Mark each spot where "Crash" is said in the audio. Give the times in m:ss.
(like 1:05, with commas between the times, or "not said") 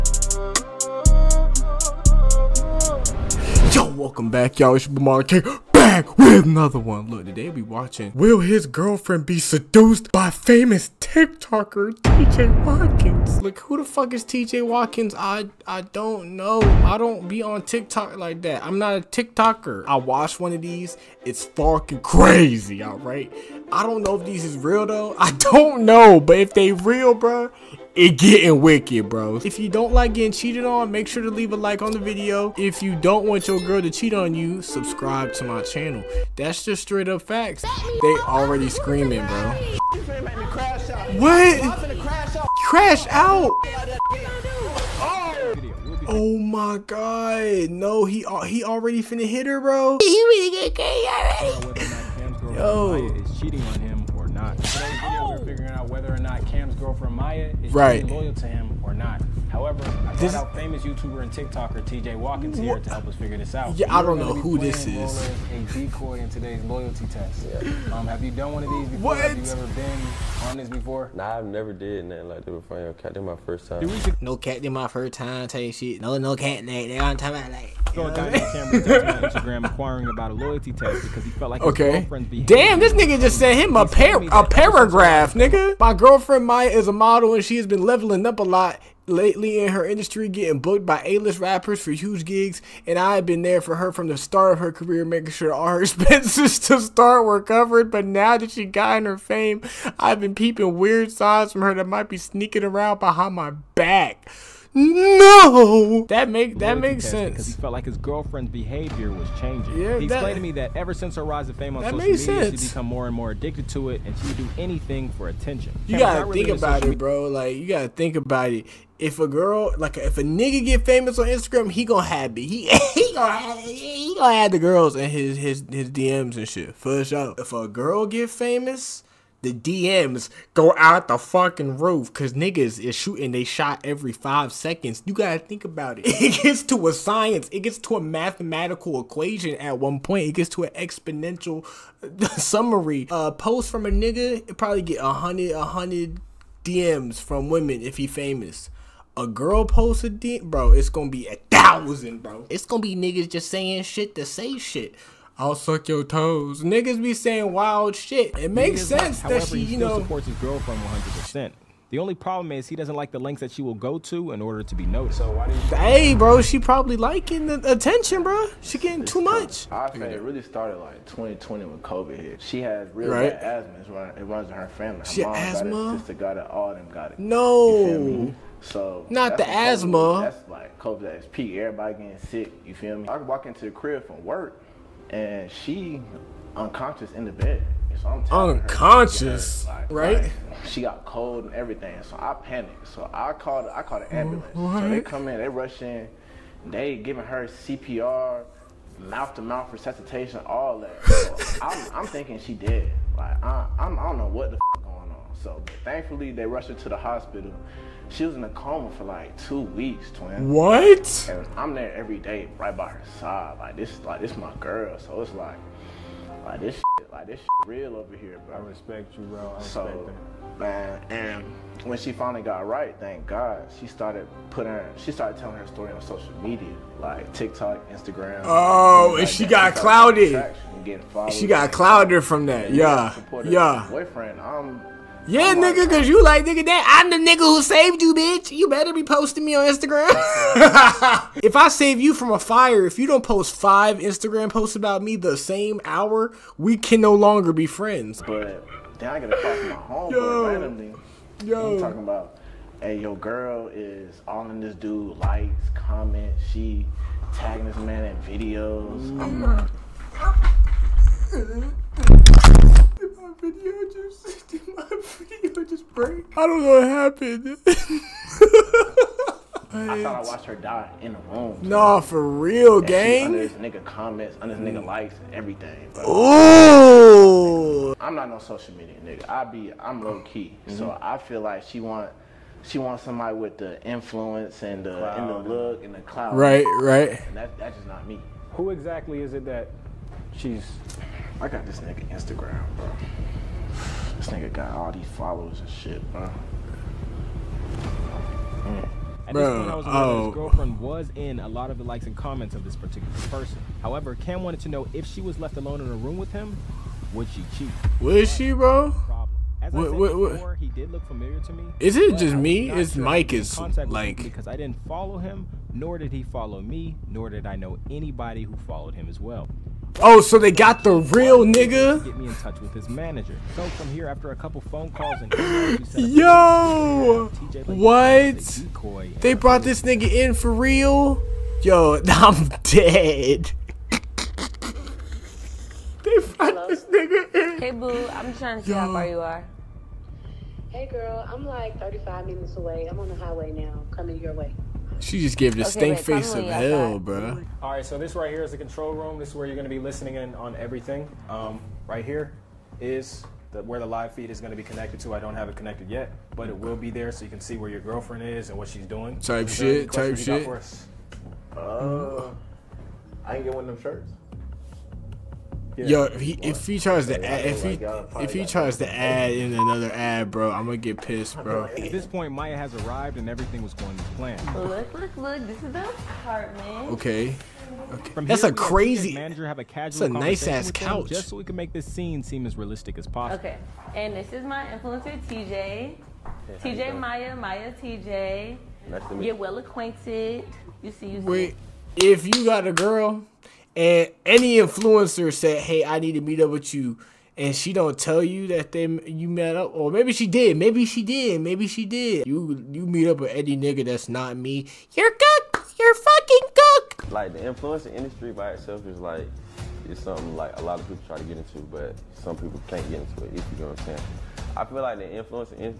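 0:42.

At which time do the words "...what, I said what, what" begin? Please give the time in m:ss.
5:09.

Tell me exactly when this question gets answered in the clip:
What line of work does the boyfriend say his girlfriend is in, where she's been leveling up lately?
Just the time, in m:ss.
1:26.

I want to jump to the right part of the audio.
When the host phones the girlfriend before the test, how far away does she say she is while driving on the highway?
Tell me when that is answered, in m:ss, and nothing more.
5:41.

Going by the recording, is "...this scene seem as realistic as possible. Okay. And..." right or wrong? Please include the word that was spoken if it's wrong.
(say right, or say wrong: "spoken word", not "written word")
right.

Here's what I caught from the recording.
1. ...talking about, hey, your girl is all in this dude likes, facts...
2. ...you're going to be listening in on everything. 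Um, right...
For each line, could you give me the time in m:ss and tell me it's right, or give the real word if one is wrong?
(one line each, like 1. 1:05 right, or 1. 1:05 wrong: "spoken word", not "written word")
1. 4:11 wrong: "comments", not "facts"
2. 5:49 right.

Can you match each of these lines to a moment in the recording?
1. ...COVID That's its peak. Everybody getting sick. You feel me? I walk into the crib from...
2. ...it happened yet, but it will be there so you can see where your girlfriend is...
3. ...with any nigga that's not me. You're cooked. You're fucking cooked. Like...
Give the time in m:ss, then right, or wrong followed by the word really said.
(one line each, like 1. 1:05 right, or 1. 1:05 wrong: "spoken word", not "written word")
1. 3:00 right
2. 5:55 wrong: "connected", not "happened"
3. 6:43 right.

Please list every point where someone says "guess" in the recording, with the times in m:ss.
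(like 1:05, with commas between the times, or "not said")
not said.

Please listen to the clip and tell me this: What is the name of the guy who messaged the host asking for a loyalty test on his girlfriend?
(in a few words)
Cameron.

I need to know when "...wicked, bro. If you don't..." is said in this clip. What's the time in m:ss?
0:28.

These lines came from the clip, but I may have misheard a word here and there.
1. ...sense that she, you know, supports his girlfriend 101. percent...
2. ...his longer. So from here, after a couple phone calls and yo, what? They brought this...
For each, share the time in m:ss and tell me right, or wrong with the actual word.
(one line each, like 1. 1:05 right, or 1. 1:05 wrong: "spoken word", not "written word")
1. 2:38 wrong: "100", not "101"
2. 5:22 wrong: "manager", not "longer".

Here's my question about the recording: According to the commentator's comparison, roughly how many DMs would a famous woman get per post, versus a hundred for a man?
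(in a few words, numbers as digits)
1000.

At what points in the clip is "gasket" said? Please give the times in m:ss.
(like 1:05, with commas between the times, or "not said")
not said.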